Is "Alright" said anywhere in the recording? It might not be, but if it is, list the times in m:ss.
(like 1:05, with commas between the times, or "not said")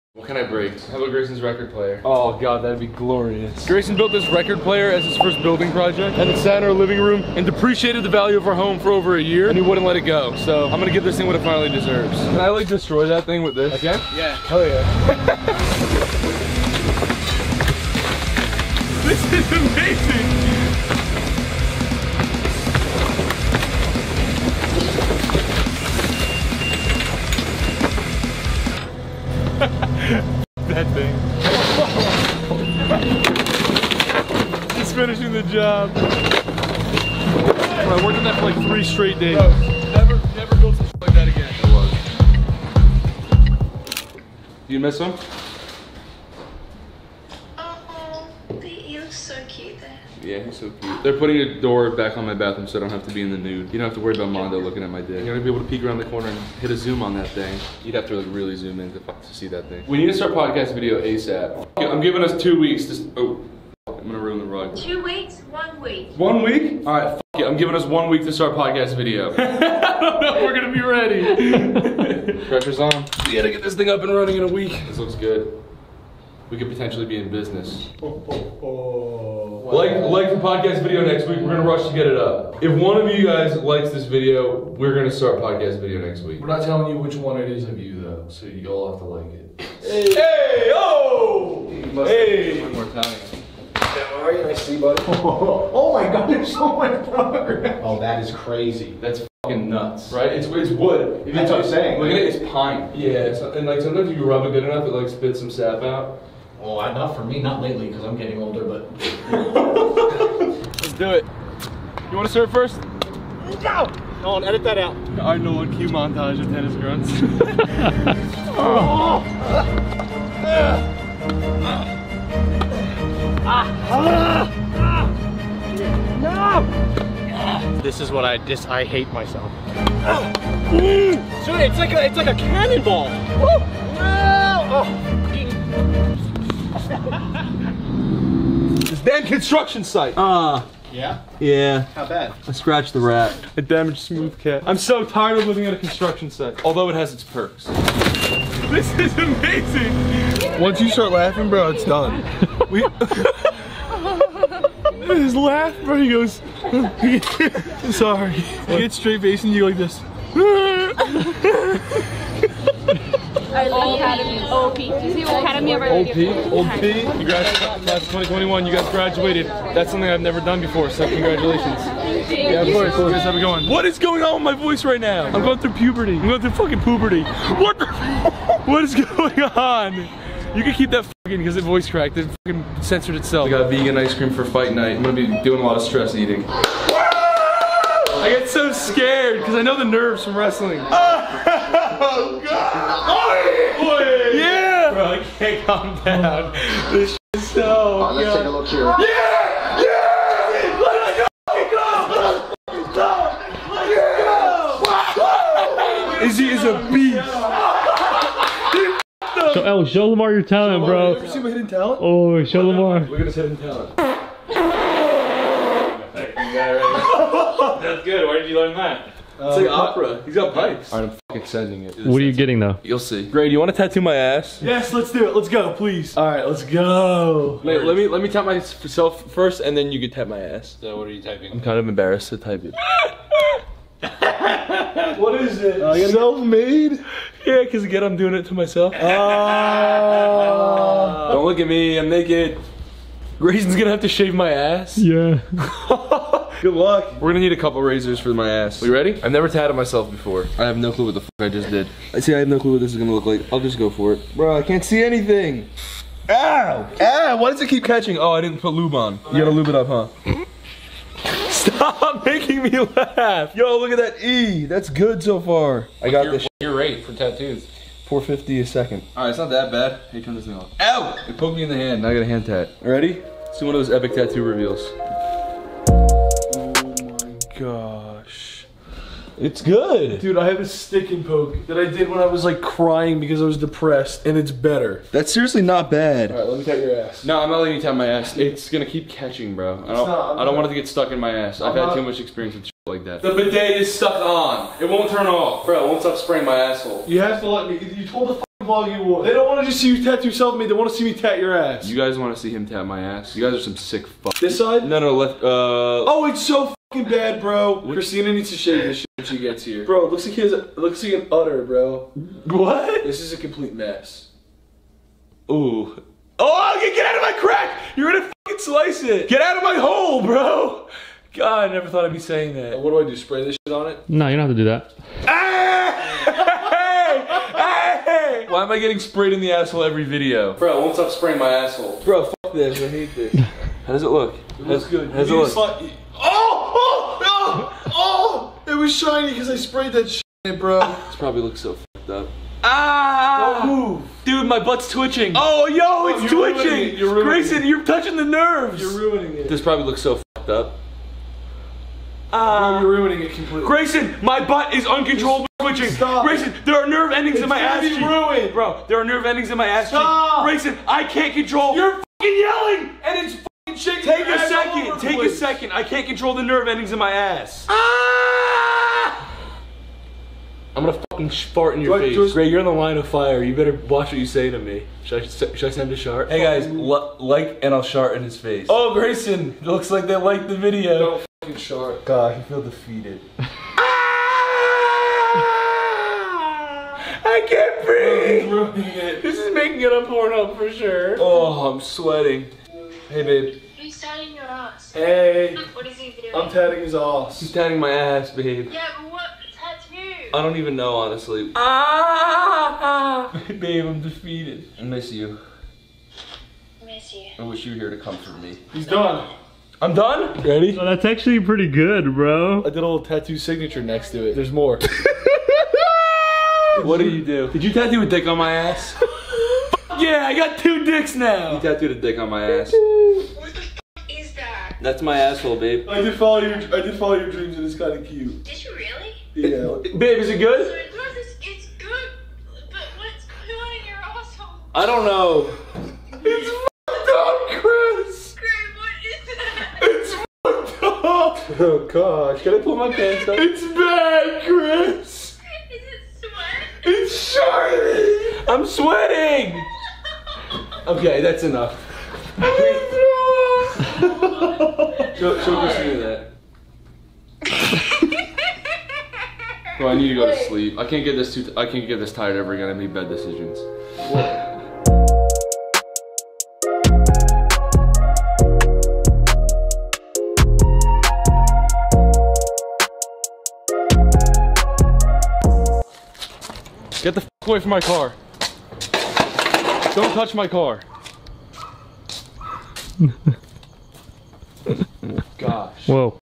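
3:18, 3:40, 3:46, 4:46.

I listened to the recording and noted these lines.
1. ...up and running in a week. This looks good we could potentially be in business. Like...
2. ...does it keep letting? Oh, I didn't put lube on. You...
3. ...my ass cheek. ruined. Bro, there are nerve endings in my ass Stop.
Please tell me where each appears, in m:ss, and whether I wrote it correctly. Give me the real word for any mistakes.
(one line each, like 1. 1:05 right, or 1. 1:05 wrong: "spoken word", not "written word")
1. 1:13 right
2. 4:17 wrong: "catching", not "letting"
3. 5:57 right.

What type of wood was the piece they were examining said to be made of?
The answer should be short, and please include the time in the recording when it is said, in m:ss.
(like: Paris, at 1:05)
Pine, at 1:42.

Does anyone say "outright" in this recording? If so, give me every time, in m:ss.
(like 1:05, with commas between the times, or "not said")
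not said.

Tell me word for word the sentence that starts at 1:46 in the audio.
Well, not for me, not lately, because I'm getting older, but.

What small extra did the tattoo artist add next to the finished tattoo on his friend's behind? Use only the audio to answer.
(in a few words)
Tattoo signature.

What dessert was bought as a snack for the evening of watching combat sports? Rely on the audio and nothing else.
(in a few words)
Vegan ice cream.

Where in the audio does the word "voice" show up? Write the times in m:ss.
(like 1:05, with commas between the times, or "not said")
2:54, 3:01.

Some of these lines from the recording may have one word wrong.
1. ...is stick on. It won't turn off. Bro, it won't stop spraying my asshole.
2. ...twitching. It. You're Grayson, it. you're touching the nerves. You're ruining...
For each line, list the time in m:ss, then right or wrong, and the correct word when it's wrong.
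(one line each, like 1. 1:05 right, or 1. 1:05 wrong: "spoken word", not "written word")
1. 4:53 wrong: "stuck", not "stick"
2. 5:46 right.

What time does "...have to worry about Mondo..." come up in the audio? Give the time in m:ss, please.
0:53.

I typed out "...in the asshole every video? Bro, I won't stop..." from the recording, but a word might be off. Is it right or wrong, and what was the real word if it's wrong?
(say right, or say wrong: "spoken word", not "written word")
right.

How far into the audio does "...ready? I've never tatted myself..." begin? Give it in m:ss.
4:08.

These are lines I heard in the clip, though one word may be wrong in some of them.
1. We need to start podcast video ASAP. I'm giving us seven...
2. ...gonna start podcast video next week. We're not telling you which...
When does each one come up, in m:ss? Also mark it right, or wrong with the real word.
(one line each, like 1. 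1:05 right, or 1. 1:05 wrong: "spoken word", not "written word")
1. 0:59 wrong: "two", not "seven"
2. 1:24 right.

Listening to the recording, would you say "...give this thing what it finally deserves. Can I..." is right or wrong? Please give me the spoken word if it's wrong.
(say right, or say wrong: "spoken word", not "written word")
right.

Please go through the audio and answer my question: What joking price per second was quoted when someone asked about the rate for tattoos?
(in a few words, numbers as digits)
450.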